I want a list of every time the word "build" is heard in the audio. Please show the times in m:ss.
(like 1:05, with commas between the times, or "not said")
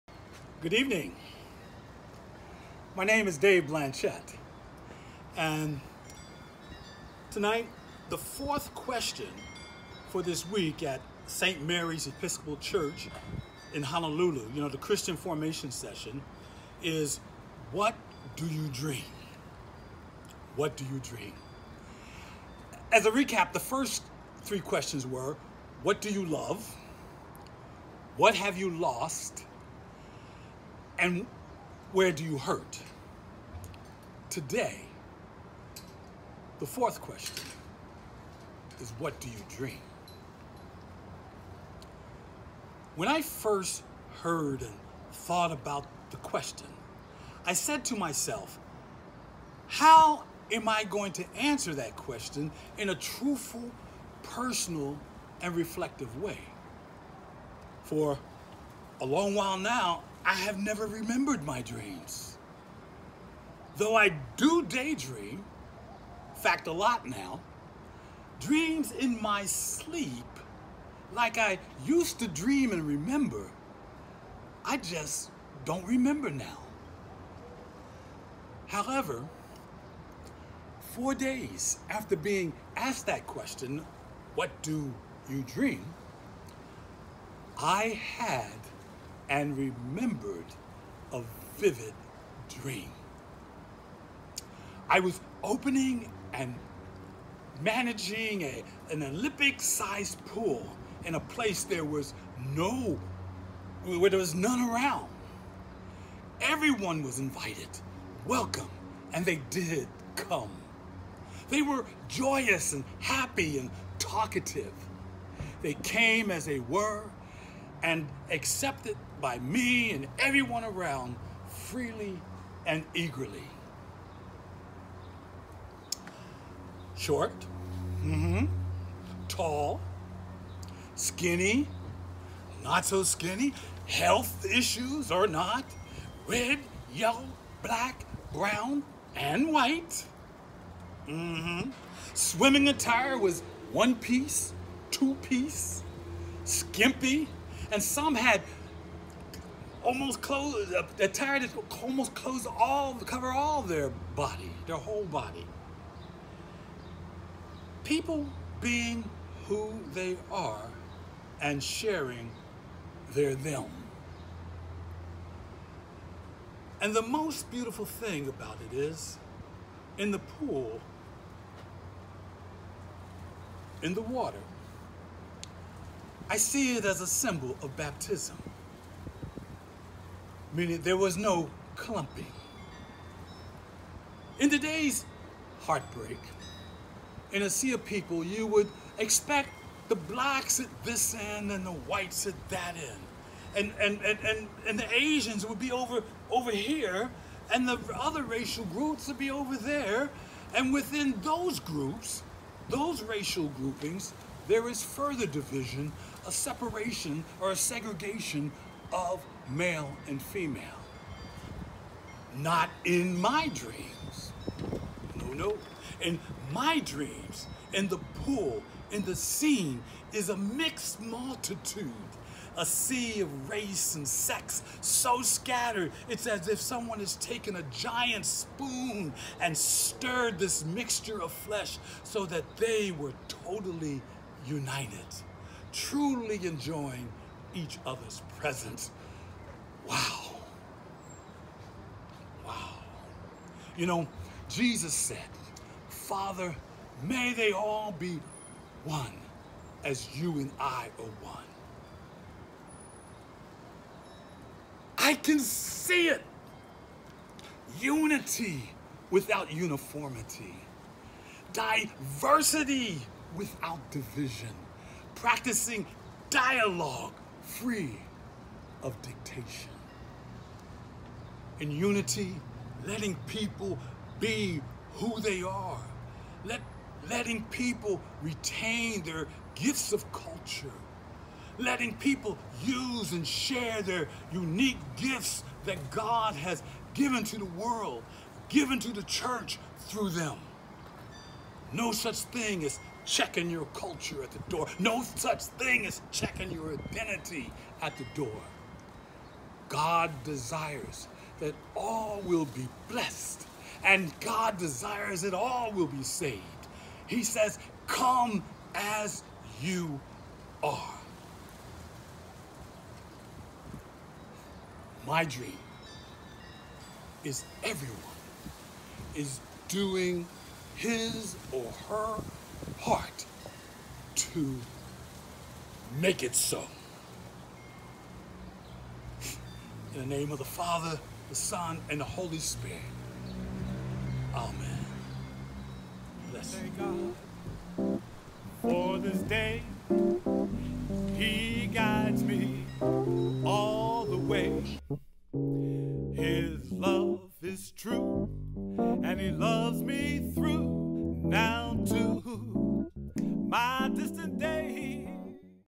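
not said.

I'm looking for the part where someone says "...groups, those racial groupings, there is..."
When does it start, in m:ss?
3:21.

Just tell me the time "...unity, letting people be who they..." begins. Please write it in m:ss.
4:31.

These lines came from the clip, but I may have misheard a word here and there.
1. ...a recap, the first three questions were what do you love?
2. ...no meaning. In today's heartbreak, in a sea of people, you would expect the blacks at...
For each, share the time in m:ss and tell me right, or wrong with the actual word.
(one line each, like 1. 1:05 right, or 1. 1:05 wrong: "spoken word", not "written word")
1. 0:23 right
2. 3:01 wrong: "clumping", not "meaning".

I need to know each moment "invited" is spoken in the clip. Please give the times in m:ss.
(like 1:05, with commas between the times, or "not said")
1:47.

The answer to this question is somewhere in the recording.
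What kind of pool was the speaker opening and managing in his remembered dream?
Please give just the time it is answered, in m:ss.
1:39.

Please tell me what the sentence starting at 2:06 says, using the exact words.
Short, mm-hmm, tall, skinny, not so skinny, health issues or not, red, yellow, black, brown, and white.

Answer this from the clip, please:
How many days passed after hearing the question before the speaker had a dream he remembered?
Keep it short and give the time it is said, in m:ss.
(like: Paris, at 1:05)
4, at 1:20.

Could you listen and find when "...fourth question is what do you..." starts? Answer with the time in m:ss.
0:36.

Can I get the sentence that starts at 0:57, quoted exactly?
For a long while now, I have never remembered my dreams.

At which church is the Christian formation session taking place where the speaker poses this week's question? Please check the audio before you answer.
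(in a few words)
St. Mary's Episcopal Church.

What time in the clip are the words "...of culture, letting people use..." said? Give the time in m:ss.
4:39.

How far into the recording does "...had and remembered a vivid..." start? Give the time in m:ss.
1:28.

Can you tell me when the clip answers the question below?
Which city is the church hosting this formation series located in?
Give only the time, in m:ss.
0:13.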